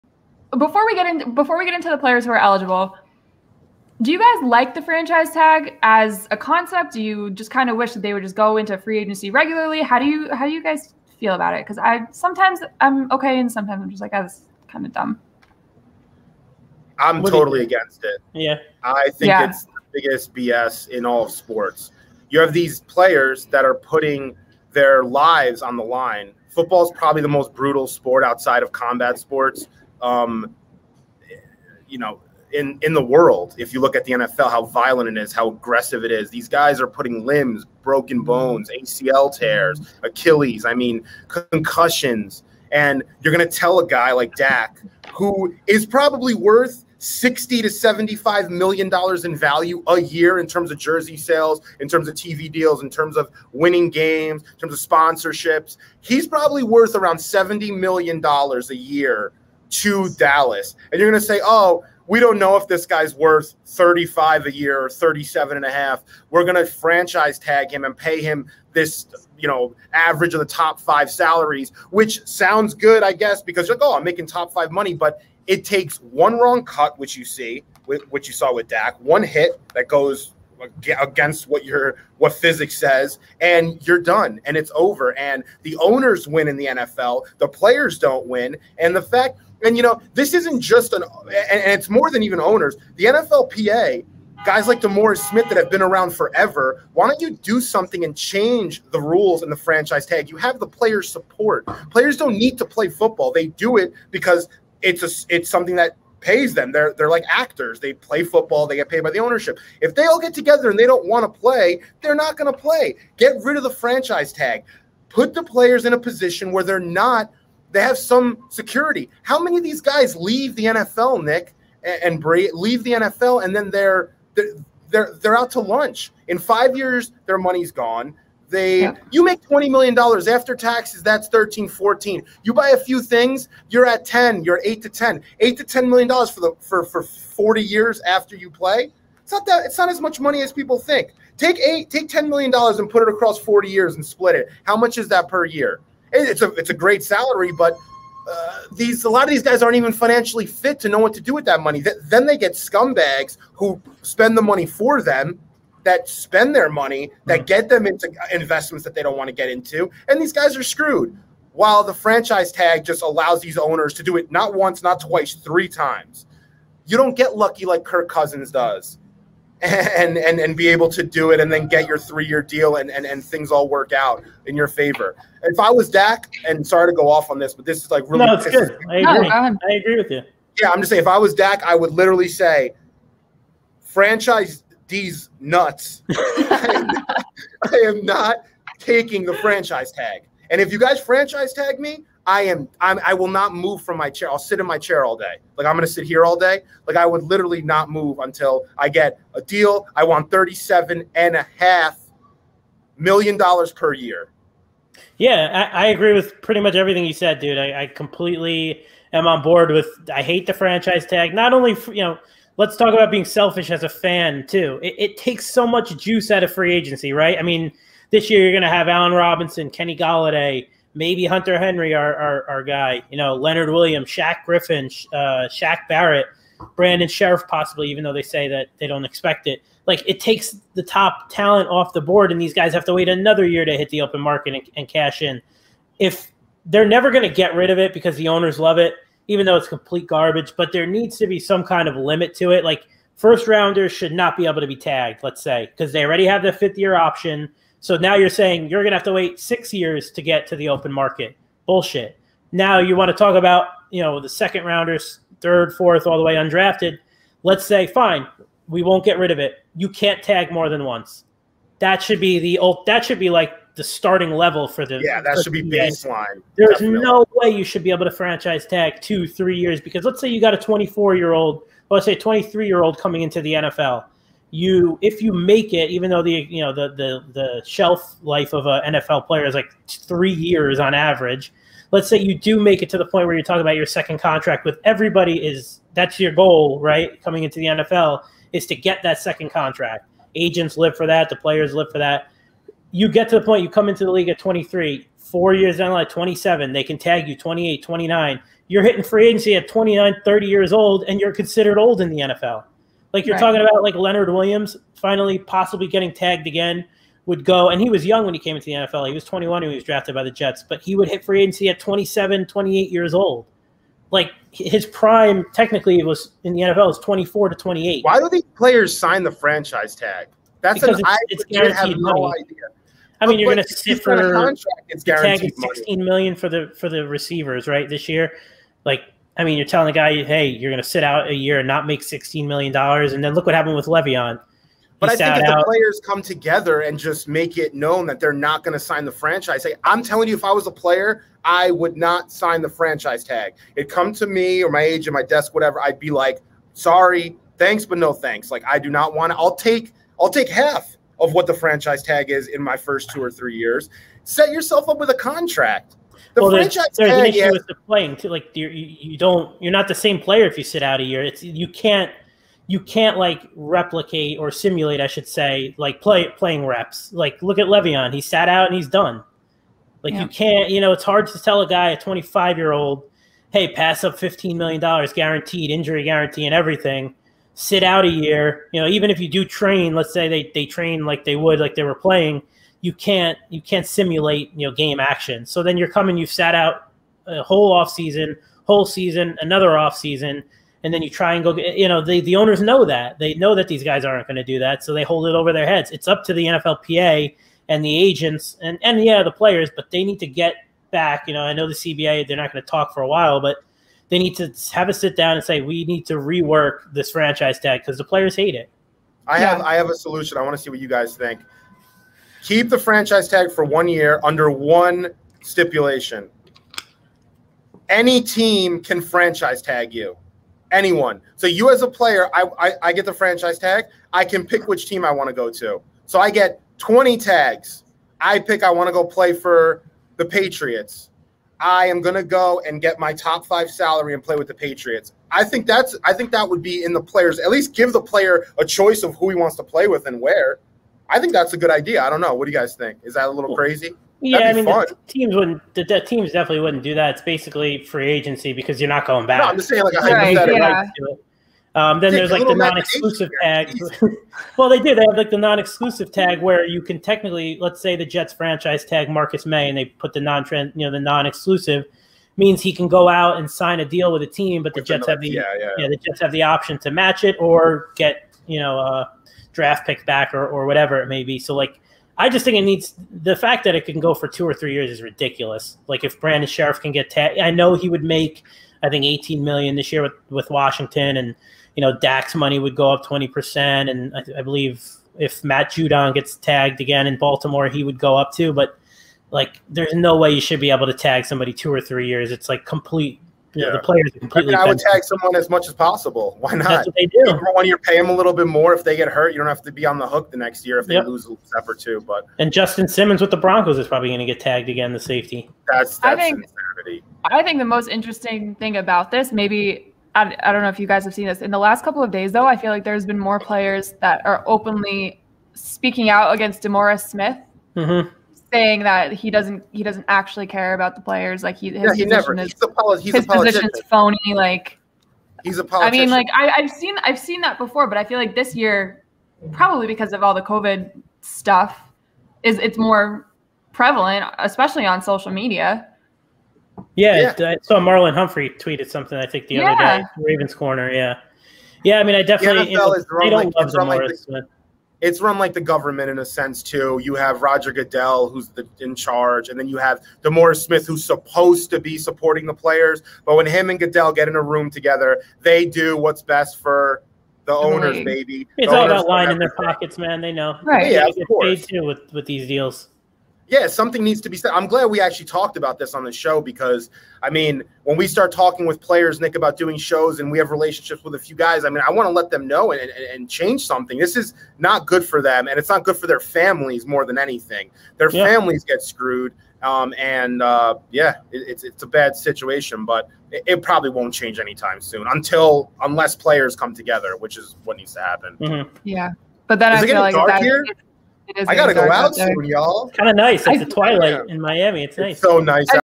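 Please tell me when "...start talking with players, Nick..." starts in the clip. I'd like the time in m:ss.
9:28.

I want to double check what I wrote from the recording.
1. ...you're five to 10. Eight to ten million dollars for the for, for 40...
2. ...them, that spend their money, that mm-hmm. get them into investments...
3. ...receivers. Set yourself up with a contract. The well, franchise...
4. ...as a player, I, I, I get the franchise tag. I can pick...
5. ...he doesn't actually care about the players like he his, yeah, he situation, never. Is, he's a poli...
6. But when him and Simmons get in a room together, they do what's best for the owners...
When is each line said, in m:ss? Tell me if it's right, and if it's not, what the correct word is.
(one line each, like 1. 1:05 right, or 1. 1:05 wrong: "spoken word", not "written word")
1. 2:14 wrong: "eight", not "five"
2. 2:35 right
3. 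5:53 wrong: "years", not "receivers"
4. 7:01 right
5. 8:39 wrong: "position", not "situation"
6. 9:13 wrong: "Goodell", not "Simmons".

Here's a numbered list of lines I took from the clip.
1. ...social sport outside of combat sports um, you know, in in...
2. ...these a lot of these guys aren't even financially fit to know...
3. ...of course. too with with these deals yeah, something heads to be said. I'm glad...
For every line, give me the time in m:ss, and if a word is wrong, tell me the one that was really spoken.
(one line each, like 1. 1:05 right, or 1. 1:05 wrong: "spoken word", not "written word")
1. 0:27 wrong: "brutal", not "social"
2. 2:28 right
3. 9:21 wrong: "needs", not "heads".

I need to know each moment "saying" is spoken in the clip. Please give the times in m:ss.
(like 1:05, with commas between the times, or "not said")
3:00, 4:08, 7:29, 8:38.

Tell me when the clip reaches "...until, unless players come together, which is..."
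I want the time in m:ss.
9:45.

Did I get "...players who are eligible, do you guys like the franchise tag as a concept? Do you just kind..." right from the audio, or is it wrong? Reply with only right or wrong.
right.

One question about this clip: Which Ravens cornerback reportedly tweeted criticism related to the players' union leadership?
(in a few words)
Marlon Humphrey.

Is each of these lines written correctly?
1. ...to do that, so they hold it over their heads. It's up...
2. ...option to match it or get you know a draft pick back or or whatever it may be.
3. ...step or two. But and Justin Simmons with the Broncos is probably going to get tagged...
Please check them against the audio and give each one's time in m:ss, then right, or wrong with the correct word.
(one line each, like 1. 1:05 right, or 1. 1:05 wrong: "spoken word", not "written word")
1. 6:34 right
2. 7:46 right
3. 8:21 right.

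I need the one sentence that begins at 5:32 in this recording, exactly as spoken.
And then look what happened with Le'Veon.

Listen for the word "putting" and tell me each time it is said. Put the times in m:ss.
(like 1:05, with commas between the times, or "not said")
0:23, 0:36.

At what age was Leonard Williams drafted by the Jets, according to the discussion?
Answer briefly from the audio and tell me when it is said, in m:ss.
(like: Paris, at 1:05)
21, at 5:09.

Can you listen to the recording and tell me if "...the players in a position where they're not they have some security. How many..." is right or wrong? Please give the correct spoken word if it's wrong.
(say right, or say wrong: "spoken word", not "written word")
right.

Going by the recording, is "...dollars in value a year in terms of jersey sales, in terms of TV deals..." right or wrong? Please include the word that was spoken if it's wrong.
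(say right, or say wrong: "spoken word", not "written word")
right.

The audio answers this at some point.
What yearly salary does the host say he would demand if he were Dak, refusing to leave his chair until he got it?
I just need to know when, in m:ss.
3:20.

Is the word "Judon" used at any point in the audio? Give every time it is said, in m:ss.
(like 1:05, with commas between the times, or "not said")
8:05.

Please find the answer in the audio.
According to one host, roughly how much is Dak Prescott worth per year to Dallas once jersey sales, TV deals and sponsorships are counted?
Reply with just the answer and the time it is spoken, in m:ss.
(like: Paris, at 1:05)
70 million dollars, at 0:57.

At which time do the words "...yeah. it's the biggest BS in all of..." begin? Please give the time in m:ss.
0:19.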